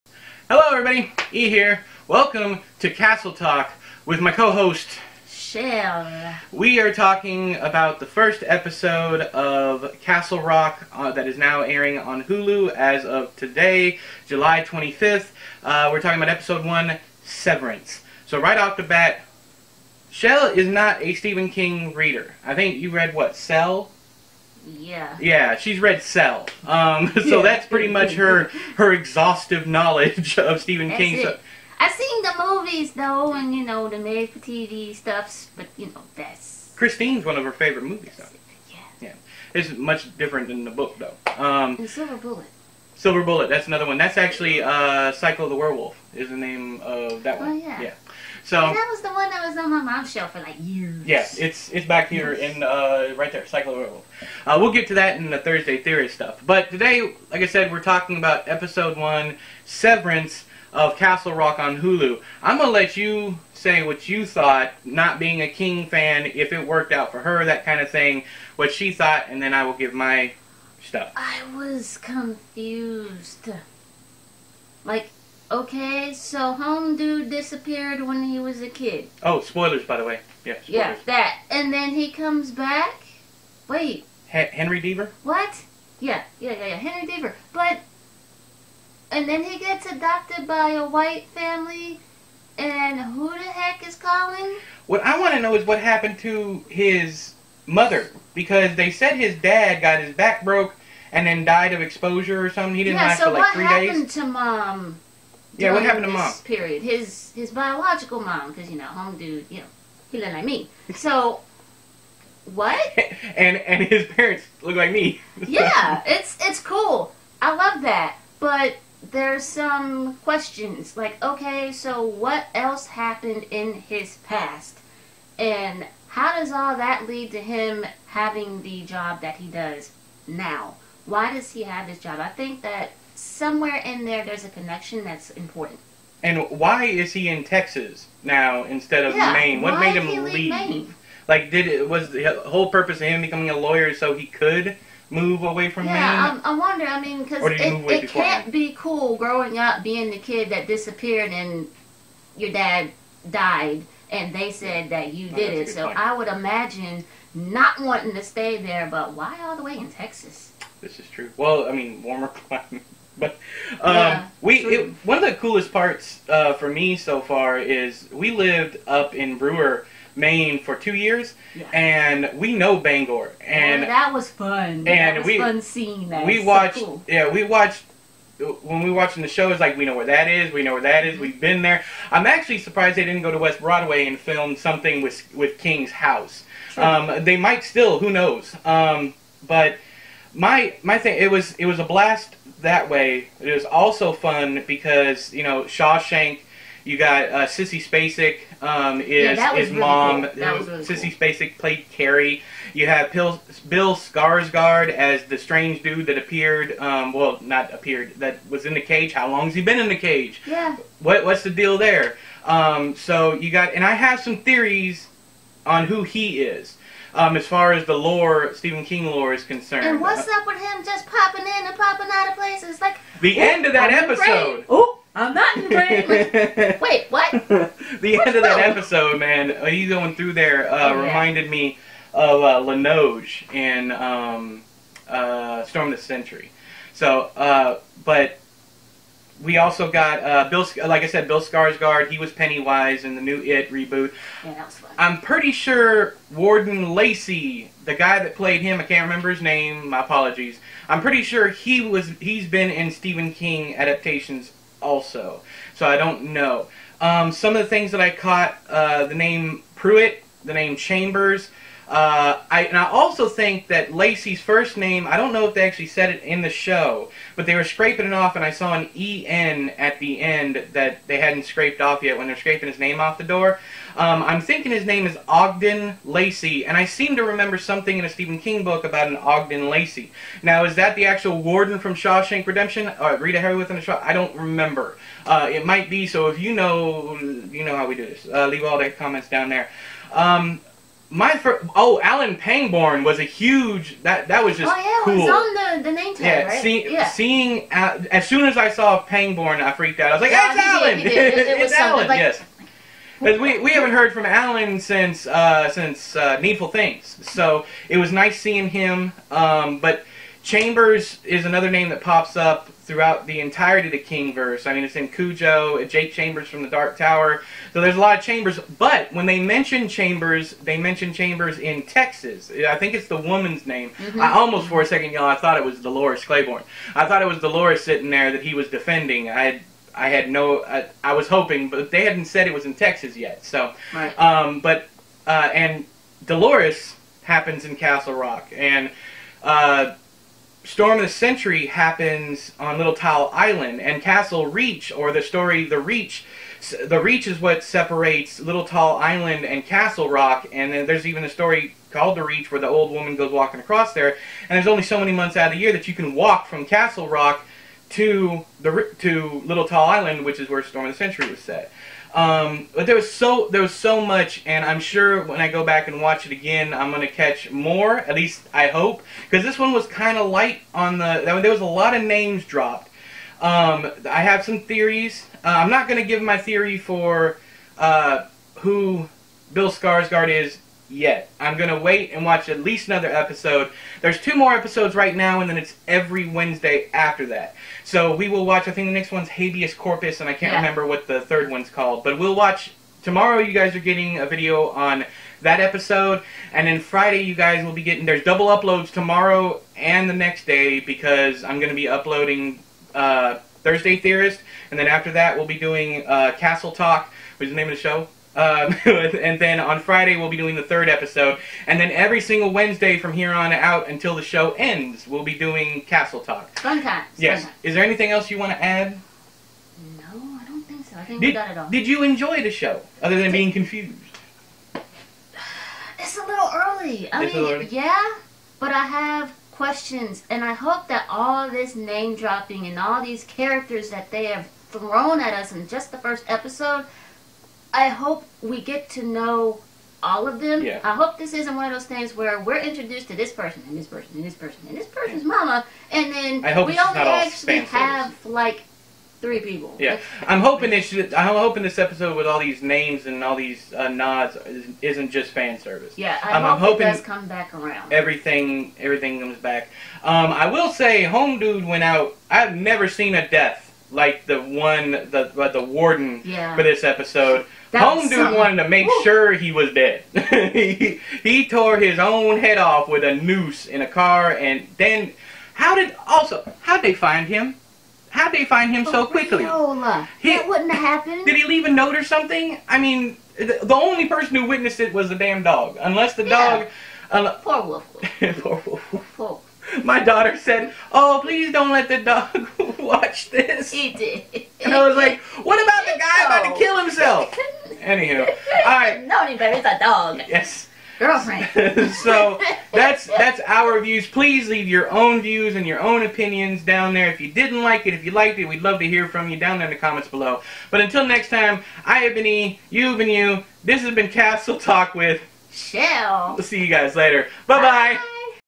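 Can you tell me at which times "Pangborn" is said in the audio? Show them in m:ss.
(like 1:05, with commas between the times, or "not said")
4:52, 4:59.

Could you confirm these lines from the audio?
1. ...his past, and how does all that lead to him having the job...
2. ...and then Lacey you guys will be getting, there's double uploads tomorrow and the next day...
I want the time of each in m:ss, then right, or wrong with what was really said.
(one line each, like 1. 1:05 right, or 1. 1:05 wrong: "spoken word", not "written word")
1. 2:03 right
2. 6:36 wrong: "Friday", not "Lacey".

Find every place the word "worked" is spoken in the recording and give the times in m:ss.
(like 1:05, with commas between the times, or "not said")
1:06.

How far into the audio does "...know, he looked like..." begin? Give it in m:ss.
1:49.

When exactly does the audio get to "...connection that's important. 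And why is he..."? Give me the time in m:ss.
2:14.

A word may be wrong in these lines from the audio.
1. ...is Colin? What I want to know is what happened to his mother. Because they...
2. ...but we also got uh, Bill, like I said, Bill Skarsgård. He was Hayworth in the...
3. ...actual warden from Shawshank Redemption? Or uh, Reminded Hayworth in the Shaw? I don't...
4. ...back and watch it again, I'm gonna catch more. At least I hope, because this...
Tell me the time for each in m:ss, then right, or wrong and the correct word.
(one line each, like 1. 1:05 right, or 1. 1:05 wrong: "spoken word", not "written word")
1. 1:33 right
2. 3:58 wrong: "Pennywise", not "Hayworth"
3. 4:41 wrong: "Rita", not "Reminded"
4. 6:05 right.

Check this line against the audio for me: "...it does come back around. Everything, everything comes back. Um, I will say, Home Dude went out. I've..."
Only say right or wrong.
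right.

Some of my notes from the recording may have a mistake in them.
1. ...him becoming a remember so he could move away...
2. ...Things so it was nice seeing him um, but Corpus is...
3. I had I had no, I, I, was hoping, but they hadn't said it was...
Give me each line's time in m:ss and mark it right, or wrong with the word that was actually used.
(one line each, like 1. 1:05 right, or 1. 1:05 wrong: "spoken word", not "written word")
1. 2:23 wrong: "lawyer", not "remember"
2. 5:06 wrong: "Chambers", not "Corpus"
3. 5:29 right.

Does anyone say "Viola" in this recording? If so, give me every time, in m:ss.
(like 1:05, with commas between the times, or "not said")
7:59.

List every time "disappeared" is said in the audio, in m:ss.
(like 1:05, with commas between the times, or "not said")
1:17, 2:30.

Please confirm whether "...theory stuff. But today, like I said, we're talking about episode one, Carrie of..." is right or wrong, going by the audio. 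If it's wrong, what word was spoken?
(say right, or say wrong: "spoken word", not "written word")
wrong: "Severance", not "Carrie".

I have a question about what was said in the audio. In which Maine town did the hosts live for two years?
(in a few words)
Brewer.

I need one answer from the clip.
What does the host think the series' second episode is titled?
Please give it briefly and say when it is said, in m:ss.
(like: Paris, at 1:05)
Habeas Corpus, at 6:29.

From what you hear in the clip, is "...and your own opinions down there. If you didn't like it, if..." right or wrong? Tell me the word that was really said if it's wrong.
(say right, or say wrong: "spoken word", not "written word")
right.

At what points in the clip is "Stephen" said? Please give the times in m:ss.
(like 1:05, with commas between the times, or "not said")
0:21, 0:30, 3:38, 4:12, 4:38.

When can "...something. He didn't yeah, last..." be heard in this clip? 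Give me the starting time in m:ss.
1:42.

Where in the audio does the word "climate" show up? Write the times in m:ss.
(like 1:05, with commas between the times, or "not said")
2:42.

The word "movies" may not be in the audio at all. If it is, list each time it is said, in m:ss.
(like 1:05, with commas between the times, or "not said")
0:32, 0:37.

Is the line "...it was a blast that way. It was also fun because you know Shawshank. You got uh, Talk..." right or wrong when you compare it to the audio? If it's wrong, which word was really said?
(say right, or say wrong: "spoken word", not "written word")
wrong: "Sissy", not "Talk".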